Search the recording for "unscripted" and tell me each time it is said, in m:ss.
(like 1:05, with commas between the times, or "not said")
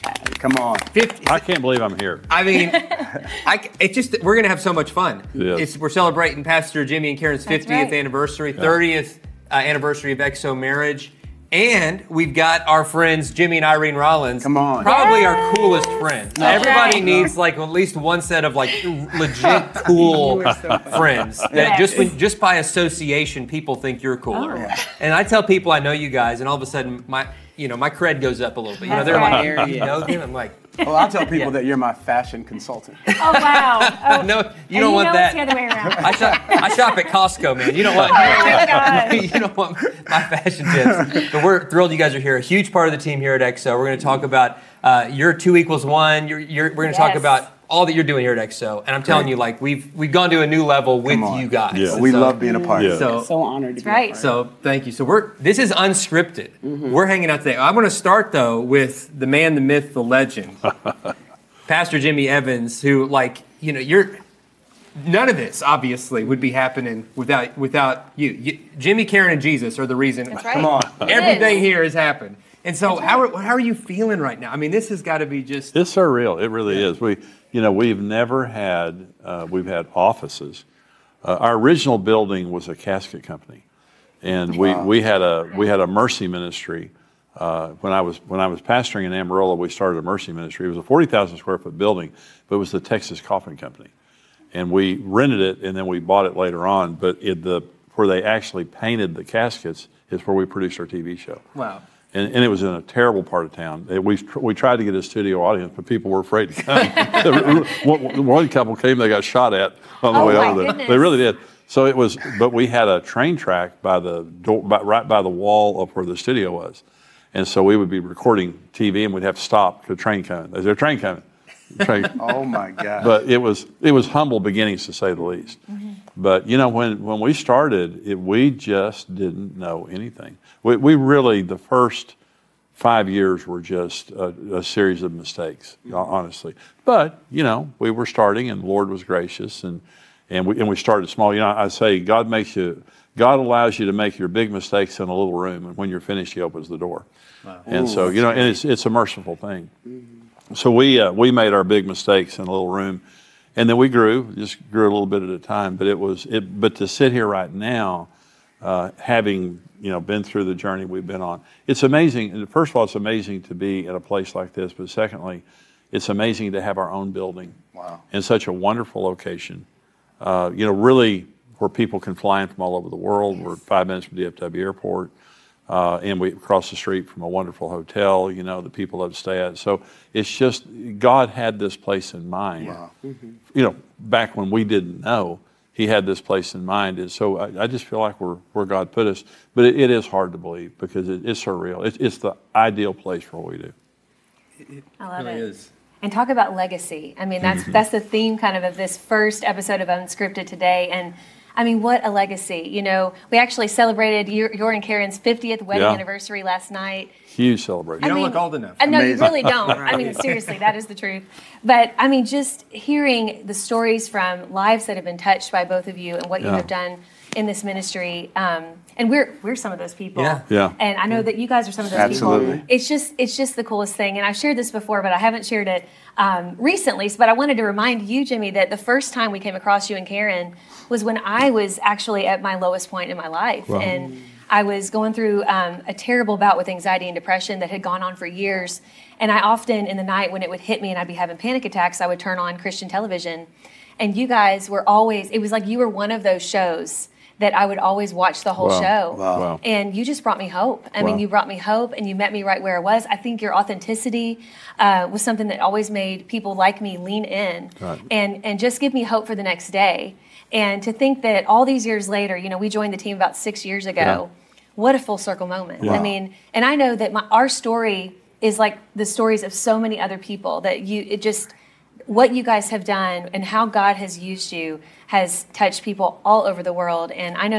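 0:55, 3:19.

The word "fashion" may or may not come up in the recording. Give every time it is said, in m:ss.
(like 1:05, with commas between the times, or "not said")
0:31, 0:40.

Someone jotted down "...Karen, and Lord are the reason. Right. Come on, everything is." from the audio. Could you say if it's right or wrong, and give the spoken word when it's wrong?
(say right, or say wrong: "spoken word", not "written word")
wrong: "Jesus", not "Lord".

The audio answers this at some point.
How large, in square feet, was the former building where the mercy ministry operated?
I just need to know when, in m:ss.
1:30.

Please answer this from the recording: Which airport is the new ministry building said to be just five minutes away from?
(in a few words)
DFW Airport.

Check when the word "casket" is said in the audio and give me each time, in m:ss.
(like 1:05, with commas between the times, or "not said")
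1:22, 1:39.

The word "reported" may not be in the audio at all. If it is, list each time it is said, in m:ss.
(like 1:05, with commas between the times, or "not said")
not said.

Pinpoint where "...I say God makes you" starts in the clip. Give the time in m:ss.
2:21.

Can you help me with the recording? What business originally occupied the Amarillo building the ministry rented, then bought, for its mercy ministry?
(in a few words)
Texas Coffin Company.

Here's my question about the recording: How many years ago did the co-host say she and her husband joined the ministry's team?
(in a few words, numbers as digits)
6.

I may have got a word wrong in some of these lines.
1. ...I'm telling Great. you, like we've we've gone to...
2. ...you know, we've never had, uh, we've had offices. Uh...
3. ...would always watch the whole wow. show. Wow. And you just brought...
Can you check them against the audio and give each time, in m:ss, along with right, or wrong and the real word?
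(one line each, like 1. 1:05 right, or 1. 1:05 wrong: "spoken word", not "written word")
1. 0:48 right
2. 1:17 right
3. 4:07 right.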